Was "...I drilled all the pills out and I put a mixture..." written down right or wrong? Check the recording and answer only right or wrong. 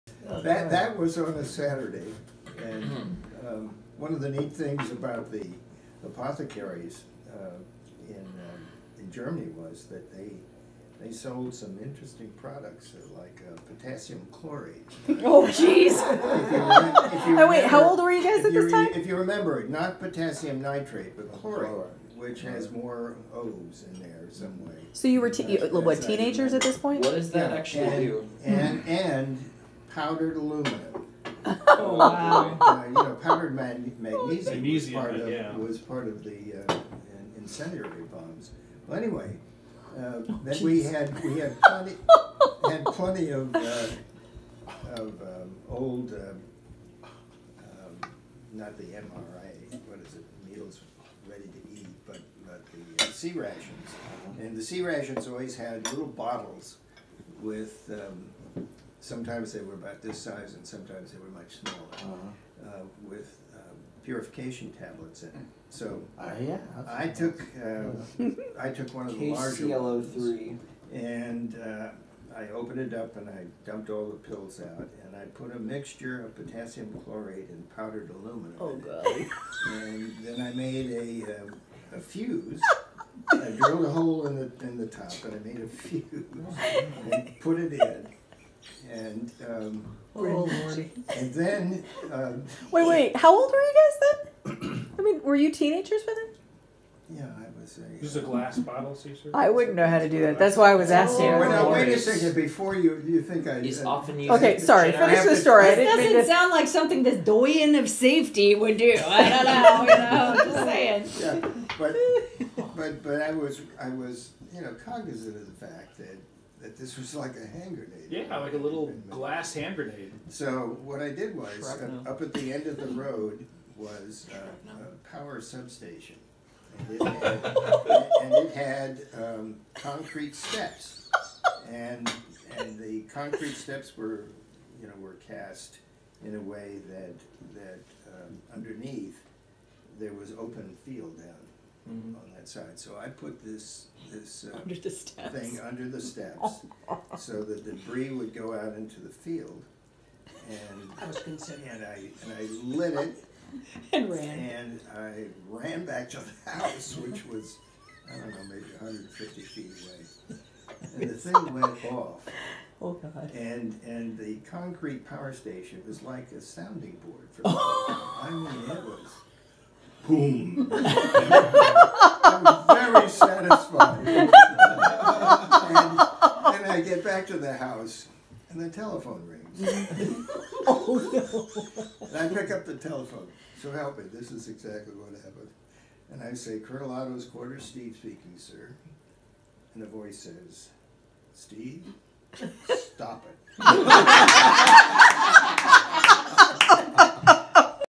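wrong.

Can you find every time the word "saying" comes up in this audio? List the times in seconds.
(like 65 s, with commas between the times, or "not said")
110 s.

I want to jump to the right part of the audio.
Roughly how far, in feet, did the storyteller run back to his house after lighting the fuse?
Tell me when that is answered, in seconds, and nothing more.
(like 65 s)
158 s.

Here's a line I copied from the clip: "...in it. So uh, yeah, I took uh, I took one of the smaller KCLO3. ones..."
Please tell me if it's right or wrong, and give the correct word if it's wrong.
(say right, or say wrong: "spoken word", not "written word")
wrong: "larger", not "smaller".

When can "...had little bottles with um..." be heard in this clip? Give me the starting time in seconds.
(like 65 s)
55 s.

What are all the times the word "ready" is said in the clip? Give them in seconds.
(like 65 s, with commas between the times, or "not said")
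51 s.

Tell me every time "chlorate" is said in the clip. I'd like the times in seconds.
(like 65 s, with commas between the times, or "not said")
14 s, 21 s, 77 s.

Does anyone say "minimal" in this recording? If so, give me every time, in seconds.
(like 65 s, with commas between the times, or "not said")
not said.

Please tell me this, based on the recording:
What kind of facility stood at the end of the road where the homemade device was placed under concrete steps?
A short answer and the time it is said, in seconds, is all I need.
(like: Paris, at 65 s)
power substation, at 125 s.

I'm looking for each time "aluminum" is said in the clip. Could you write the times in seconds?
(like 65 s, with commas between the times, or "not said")
30 s, 78 s.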